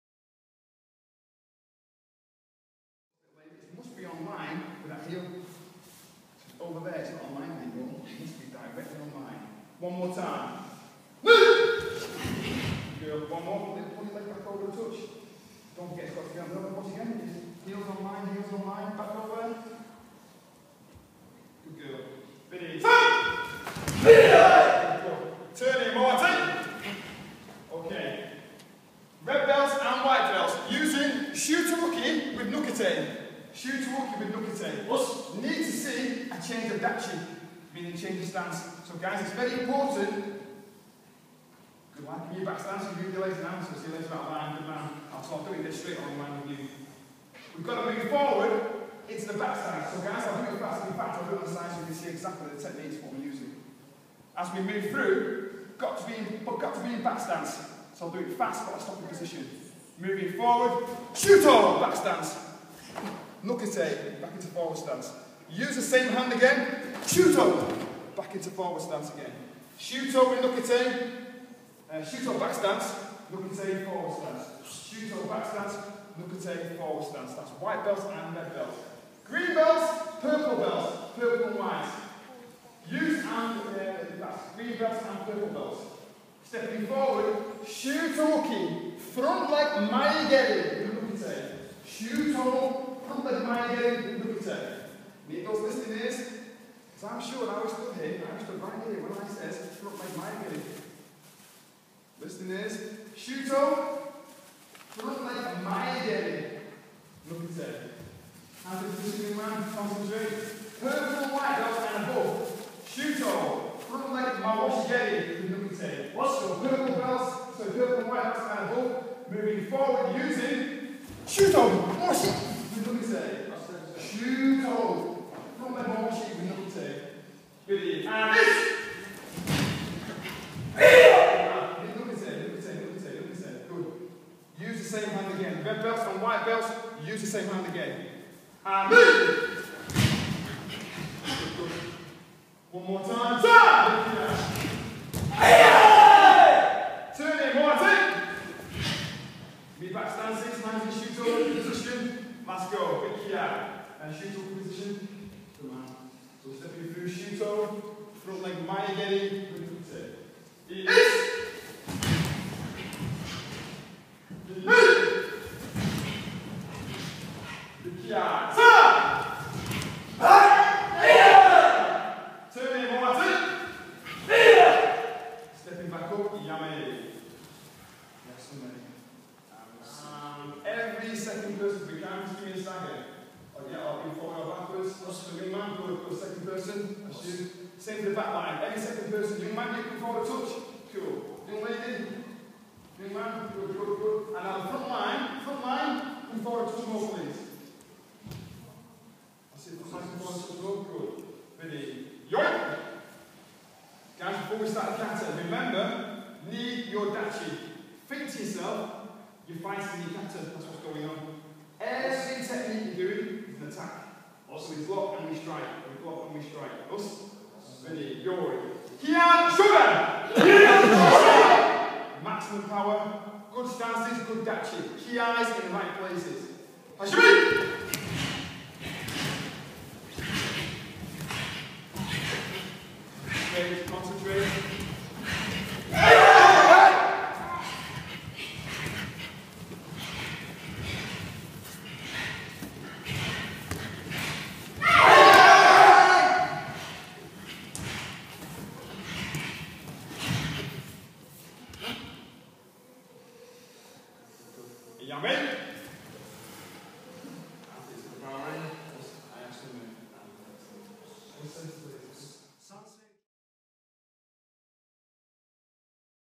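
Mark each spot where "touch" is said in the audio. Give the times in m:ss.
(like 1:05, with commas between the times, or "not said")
0:14, 3:10, 3:16, 3:20.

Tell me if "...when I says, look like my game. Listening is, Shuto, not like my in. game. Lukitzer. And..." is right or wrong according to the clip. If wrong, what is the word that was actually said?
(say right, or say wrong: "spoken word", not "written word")
right.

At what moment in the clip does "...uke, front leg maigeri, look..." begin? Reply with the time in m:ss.
1:28.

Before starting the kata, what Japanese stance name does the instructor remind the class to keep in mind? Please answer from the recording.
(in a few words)
knee your dachi.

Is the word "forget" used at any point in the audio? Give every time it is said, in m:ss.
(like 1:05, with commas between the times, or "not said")
0:15.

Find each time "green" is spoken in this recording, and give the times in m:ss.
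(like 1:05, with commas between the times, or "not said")
1:19, 1:24.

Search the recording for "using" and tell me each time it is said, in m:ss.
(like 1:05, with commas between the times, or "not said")
0:53, 2:00.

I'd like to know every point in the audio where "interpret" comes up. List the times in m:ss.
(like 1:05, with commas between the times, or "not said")
not said.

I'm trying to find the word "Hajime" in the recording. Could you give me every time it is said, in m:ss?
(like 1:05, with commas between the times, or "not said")
3:46.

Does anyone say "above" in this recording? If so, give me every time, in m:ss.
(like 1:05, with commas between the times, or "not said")
1:52, 1:58.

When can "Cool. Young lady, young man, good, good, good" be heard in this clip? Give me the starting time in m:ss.
3:10.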